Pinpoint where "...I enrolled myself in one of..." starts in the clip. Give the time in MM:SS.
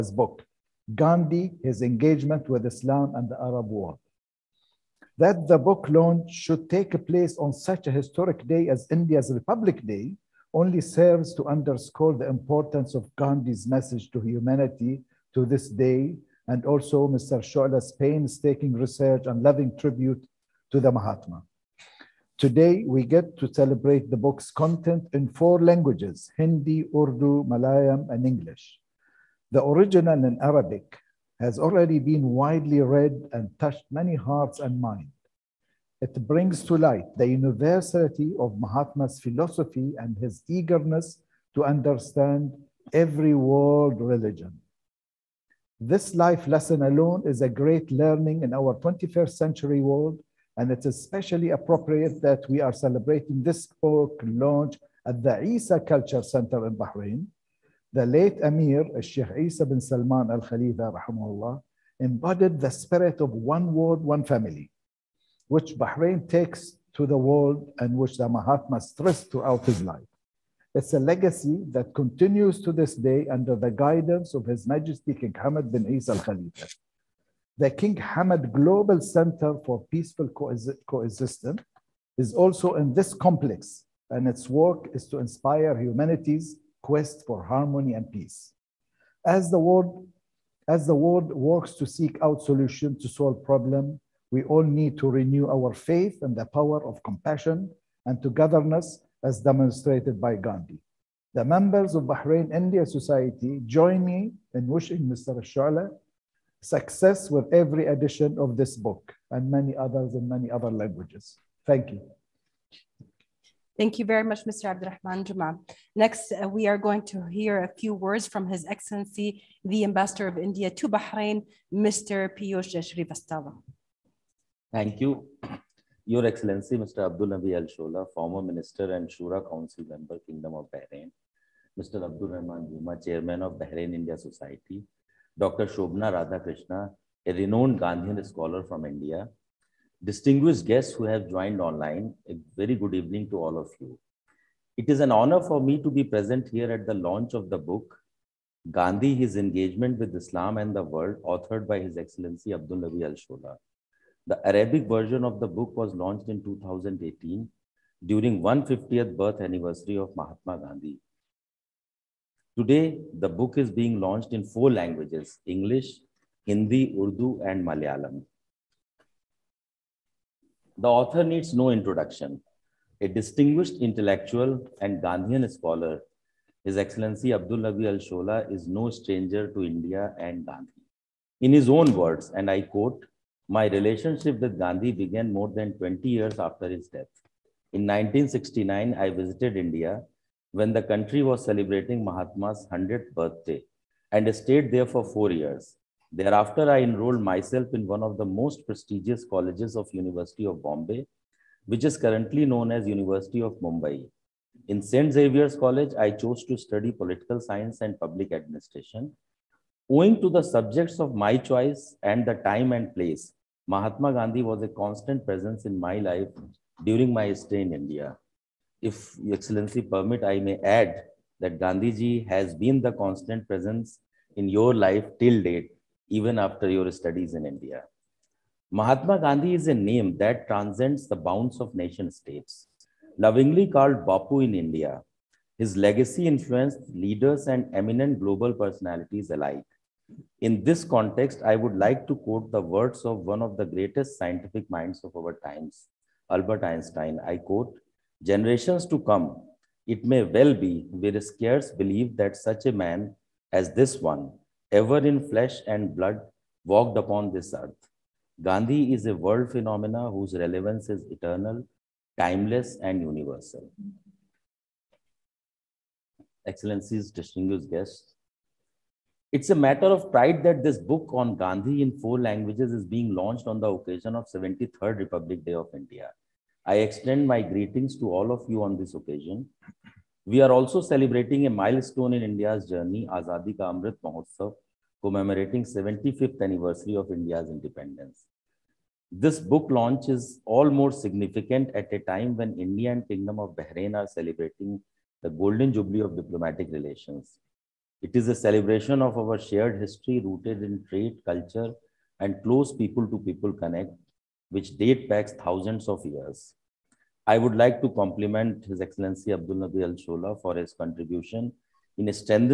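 03:16.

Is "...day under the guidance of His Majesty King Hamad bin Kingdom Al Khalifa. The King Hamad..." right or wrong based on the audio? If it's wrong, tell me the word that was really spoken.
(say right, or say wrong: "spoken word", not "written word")
wrong: "Isa", not "Kingdom".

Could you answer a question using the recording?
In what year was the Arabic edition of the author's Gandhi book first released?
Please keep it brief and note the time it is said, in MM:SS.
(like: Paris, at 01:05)
2018, at 02:36.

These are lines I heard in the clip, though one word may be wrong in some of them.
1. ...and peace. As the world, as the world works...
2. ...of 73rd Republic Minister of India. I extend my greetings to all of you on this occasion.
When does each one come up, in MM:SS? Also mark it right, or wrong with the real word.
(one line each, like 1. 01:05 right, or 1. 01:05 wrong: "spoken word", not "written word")
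1. 01:27 right
2. 04:34 wrong: "Day", not "Minister".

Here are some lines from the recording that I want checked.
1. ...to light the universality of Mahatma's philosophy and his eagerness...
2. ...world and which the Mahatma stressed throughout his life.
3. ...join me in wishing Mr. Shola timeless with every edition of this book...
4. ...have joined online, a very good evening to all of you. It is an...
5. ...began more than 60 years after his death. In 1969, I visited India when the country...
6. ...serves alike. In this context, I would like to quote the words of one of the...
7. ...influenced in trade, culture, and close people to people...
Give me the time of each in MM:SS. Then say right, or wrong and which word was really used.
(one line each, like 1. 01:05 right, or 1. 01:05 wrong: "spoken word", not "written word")
1. 00:36 right
2. 01:07 right
3. 01:43 wrong: "success", not "timeless"
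4. 02:21 right
5. 03:04 wrong: "20", not "60"
6. 03:58 wrong: "personalities", not "serves"
7. 05:00 wrong: "rooted", not "influenced".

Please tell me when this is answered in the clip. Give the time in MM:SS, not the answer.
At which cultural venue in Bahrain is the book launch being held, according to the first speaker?
00:55.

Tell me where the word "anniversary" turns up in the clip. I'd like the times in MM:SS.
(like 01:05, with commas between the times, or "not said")
02:39, 04:46.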